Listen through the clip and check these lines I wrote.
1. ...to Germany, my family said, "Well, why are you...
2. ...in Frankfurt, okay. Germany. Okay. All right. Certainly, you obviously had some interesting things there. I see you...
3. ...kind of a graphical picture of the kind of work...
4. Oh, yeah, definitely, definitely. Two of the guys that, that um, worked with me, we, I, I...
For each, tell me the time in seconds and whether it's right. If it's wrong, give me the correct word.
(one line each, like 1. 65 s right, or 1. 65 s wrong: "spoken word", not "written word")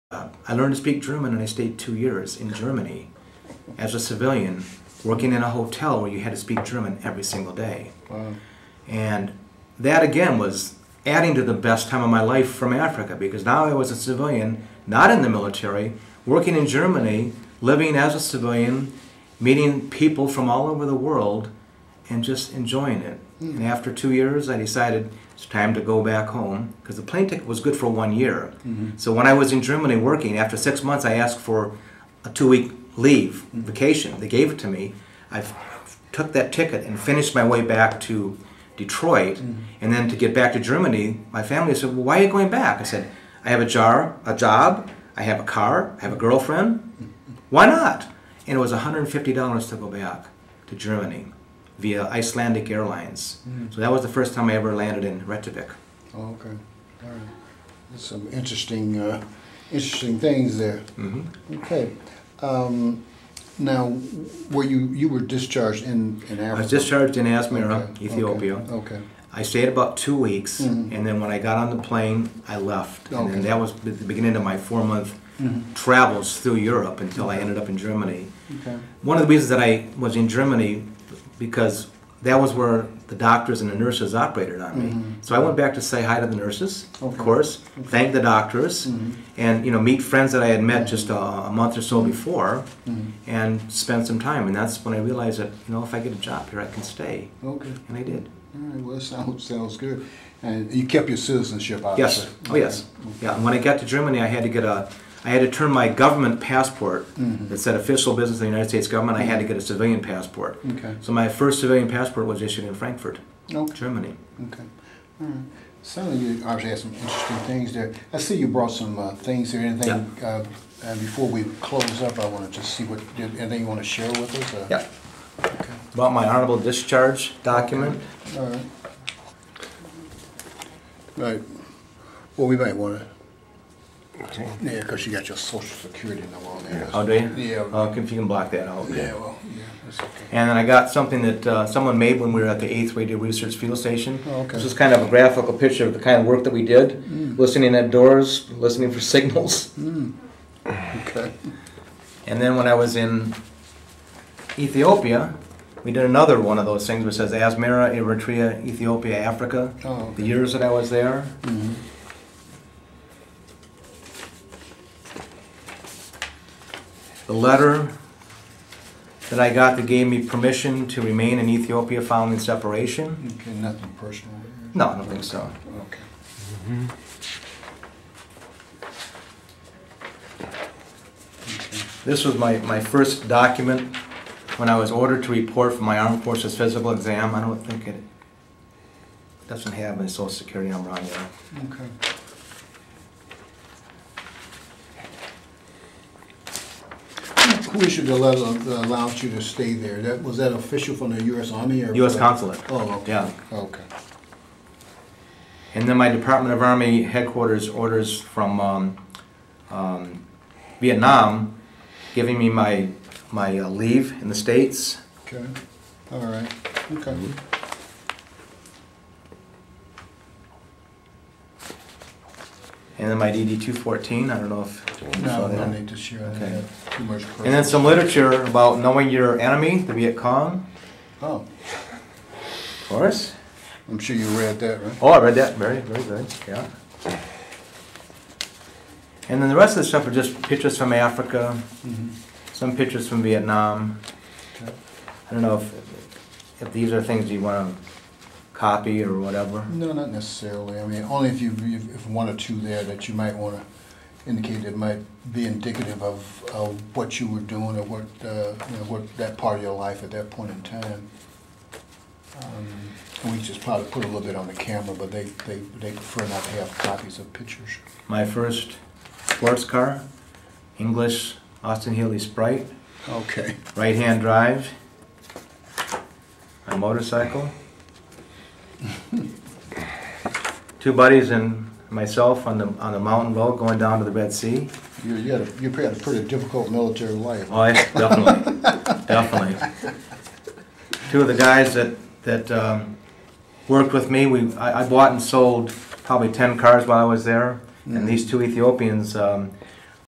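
1. 40 s right
2. 112 s right
3. 144 s right
4. 287 s right.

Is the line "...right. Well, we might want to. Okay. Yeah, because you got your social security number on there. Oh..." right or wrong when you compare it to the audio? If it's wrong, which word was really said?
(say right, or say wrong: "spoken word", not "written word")
right.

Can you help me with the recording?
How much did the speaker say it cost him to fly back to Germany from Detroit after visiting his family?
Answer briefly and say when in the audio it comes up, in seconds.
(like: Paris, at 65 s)
$150, at 48 s.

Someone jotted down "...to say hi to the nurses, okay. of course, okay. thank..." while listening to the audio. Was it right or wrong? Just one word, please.
right.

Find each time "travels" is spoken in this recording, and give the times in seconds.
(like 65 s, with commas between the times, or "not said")
75 s.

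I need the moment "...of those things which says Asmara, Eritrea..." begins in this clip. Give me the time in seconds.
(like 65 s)
156 s.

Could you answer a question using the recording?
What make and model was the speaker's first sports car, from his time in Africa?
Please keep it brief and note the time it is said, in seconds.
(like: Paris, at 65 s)
Austin Healey Sprite, at 271 s.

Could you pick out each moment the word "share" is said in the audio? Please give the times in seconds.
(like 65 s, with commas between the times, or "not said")
123 s, 225 s.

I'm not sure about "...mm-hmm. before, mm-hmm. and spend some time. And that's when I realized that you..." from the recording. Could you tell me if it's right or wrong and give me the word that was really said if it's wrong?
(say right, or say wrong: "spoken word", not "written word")
right.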